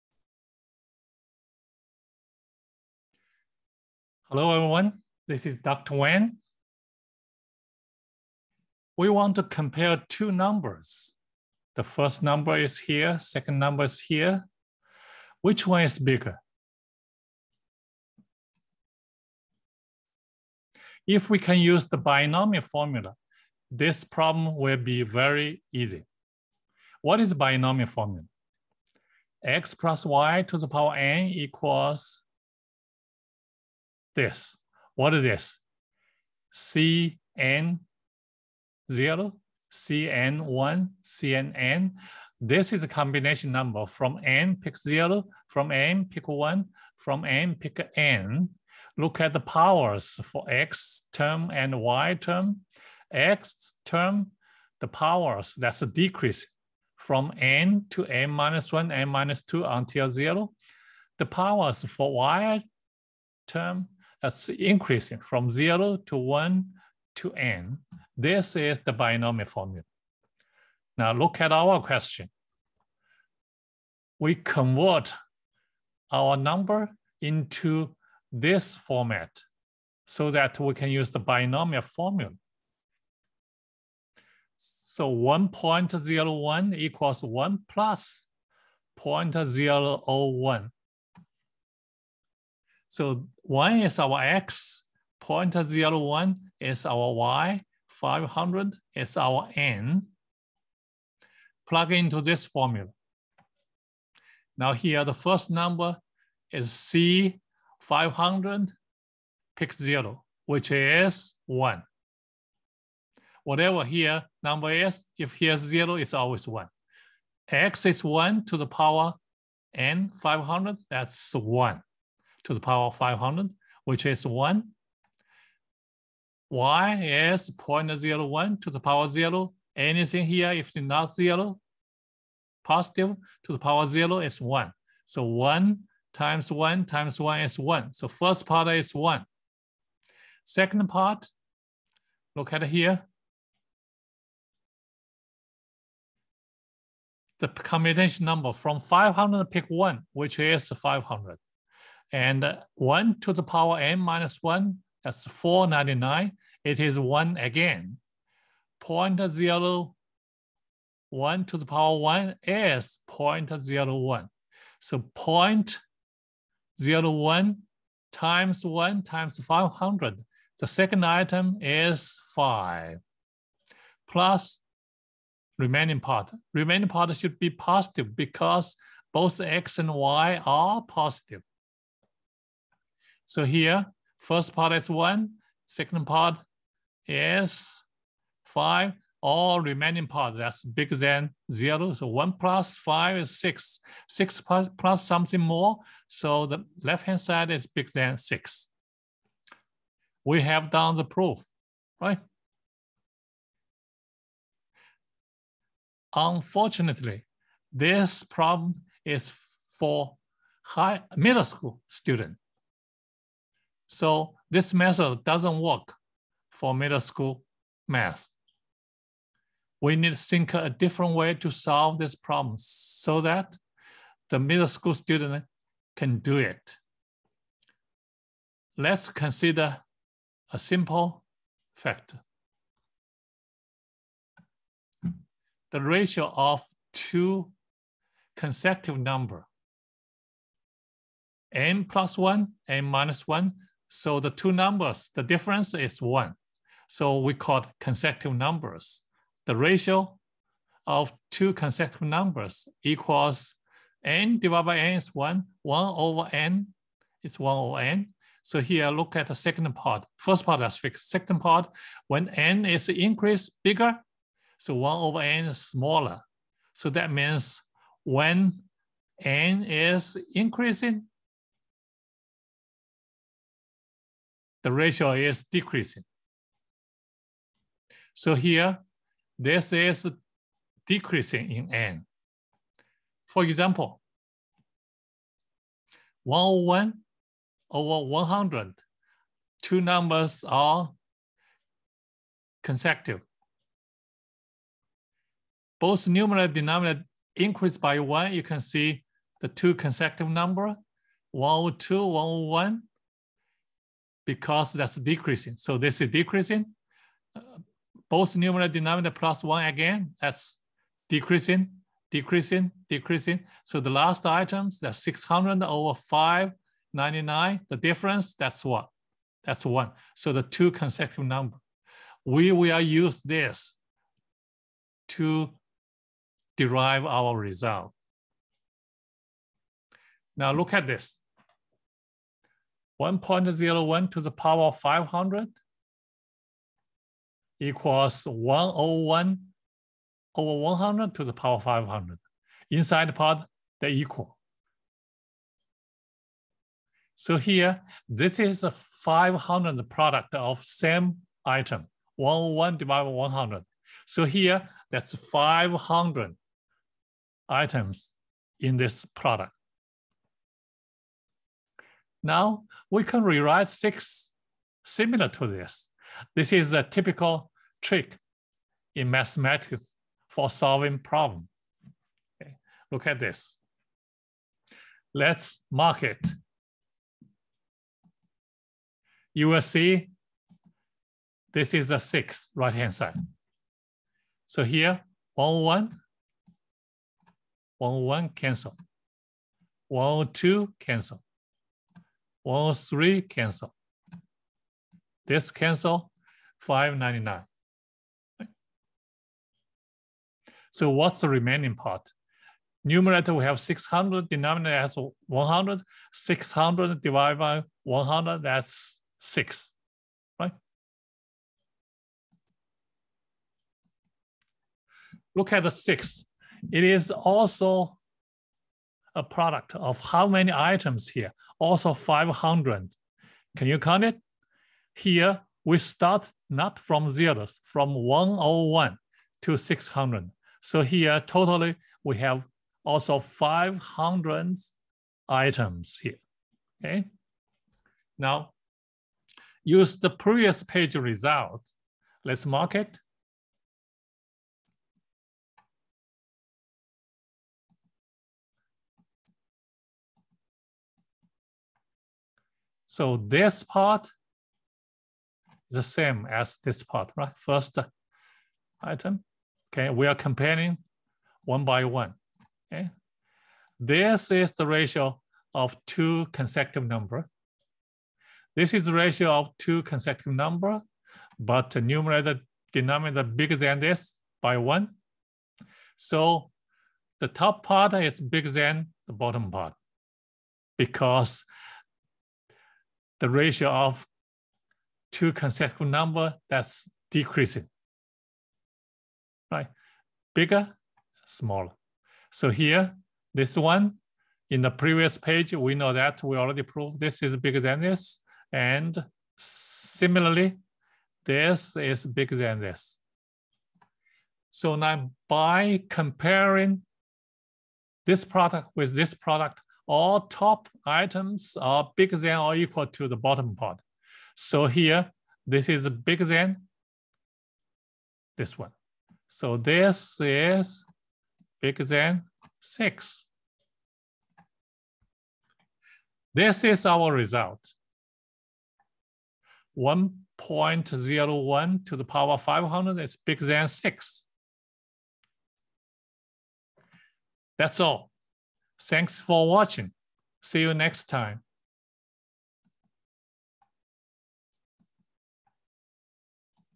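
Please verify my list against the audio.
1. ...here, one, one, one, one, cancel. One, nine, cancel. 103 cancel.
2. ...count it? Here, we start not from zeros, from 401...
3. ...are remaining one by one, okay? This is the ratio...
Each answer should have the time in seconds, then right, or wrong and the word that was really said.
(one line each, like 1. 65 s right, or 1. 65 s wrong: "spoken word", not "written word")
1. 384 s wrong: "two", not "nine"
2. 423 s wrong: "101", not "401"
3. 460 s wrong: "comparing", not "remaining".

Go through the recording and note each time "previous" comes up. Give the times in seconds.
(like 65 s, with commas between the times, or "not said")
440 s, 494 s.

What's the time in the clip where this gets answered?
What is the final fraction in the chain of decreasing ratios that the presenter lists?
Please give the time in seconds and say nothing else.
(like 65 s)
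314 s.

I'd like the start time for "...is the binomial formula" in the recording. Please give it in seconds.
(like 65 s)
68 s.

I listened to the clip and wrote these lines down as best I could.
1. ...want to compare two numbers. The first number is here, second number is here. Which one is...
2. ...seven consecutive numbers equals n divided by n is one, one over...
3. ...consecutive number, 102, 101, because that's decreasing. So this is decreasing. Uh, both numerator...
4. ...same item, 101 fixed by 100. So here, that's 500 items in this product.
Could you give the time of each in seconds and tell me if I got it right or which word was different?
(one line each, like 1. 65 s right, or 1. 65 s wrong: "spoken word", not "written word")
1. 9 s right
2. 251 s wrong: "two", not "seven"
3. 299 s right
4. 350 s wrong: "divided", not "fixed".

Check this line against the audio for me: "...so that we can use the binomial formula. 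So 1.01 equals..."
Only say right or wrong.
right.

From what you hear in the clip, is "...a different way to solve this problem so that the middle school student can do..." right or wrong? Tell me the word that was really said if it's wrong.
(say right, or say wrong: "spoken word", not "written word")
right.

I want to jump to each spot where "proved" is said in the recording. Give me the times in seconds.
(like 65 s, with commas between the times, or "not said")
496 s.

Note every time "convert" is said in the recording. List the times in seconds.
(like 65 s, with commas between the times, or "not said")
74 s.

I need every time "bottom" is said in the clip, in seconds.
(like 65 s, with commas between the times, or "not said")
479 s, 513 s.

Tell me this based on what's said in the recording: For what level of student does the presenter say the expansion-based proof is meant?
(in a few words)
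high middle school.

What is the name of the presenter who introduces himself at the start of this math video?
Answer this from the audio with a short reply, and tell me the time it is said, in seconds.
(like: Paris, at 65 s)
Dr. Wang, at 5 s.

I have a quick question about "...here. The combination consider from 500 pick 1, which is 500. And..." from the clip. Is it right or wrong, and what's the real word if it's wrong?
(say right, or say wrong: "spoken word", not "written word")
wrong: "number", not "consider".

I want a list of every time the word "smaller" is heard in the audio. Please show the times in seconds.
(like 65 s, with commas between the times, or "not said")
265 s, 491 s.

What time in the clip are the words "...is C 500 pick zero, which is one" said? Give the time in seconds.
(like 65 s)
106 s.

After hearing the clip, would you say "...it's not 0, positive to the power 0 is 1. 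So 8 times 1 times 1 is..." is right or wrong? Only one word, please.
wrong.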